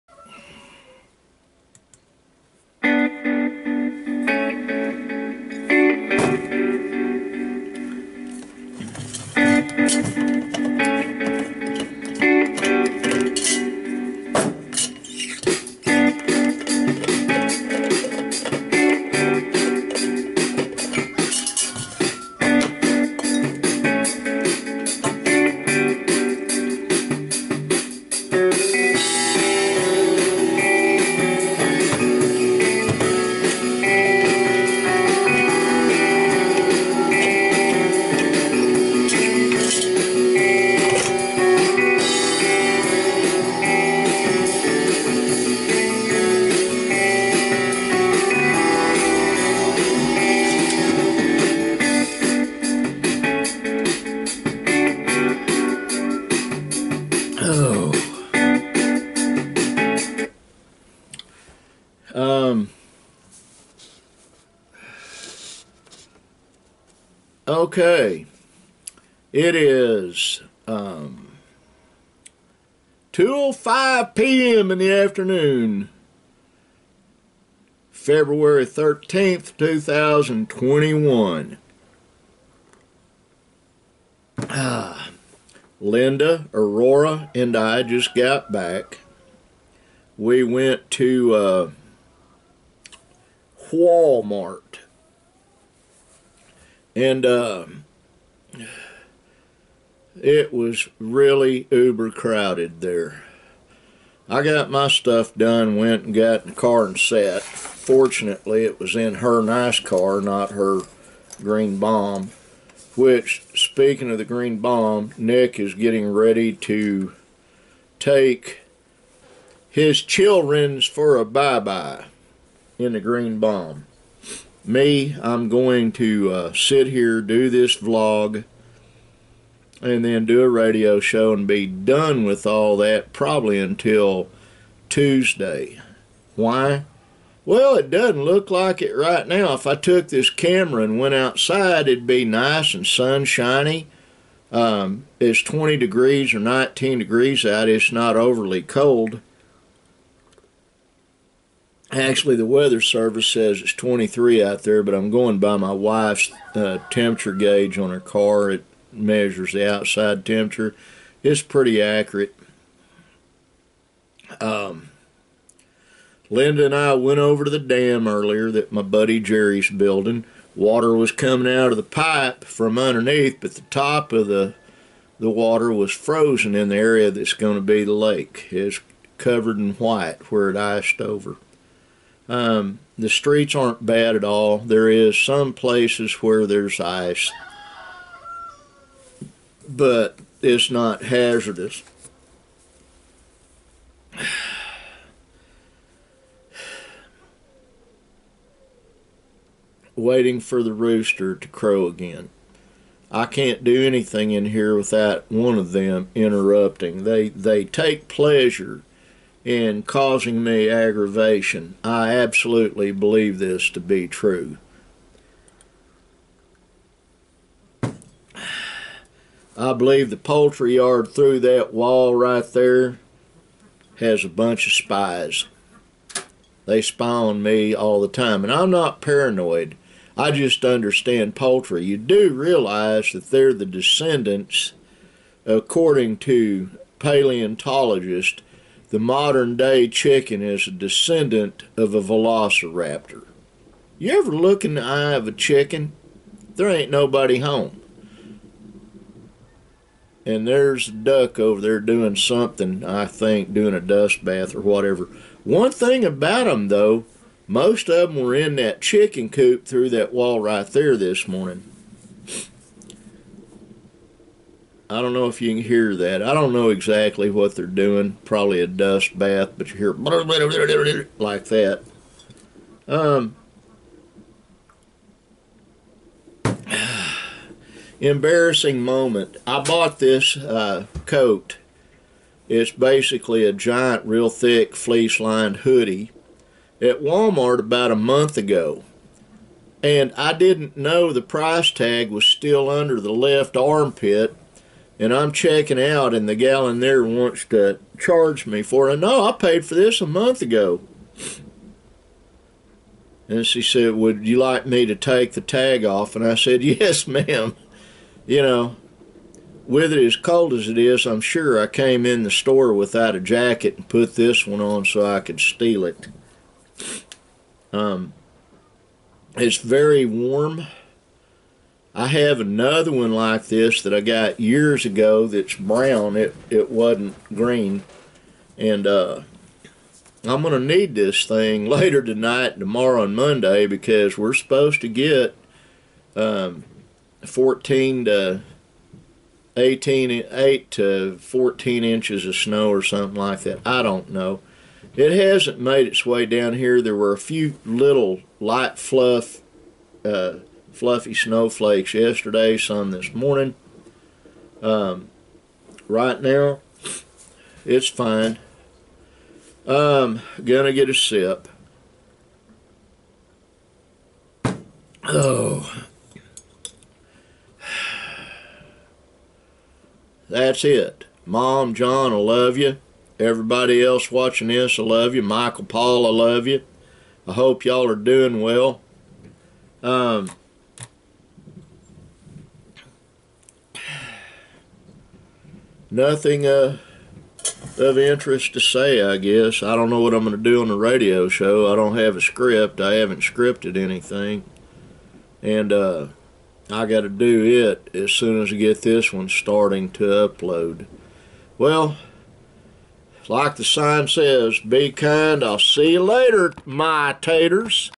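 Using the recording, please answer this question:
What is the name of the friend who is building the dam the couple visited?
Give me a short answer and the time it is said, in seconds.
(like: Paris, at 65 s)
Jerry, at 169 s.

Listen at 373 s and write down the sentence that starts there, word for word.
Everybody else watching this, I love you.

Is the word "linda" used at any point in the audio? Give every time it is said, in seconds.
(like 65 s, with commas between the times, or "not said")
85 s, 166 s.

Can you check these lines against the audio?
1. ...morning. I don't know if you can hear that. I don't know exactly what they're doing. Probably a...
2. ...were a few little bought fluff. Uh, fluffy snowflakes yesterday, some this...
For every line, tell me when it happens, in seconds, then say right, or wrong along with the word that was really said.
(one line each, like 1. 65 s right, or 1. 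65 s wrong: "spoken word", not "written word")
1. 261 s right
2. 346 s wrong: "light", not "bought".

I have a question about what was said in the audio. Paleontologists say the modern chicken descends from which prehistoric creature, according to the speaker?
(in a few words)
velociraptor.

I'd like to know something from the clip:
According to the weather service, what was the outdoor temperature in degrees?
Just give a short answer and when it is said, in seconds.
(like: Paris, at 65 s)
23, at 153 s.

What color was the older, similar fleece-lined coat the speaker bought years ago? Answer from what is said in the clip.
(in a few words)
brown.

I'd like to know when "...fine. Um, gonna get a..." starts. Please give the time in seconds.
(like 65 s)
357 s.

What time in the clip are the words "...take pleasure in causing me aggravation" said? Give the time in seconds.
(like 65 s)
207 s.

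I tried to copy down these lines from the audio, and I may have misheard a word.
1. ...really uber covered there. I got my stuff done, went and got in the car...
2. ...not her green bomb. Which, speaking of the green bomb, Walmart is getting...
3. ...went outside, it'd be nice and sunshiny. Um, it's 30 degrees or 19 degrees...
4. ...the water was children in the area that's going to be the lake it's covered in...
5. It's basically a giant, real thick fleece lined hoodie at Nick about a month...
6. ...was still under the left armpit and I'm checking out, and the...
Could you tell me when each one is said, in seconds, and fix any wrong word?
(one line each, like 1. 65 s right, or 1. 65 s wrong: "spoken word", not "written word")
1. 100 s wrong: "crowded", not "covered"
2. 110 s wrong: "Nick", not "Walmart"
3. 140 s wrong: "20", not "30"
4. 175 s wrong: "frozen", not "children"
5. 282 s wrong: "Walmart", not "Nick"
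6. 292 s right.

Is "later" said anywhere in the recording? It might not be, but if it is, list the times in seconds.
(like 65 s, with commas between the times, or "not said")
331 s, 406 s.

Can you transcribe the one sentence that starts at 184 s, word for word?
There is some places where there's ice, but it's not hazardous.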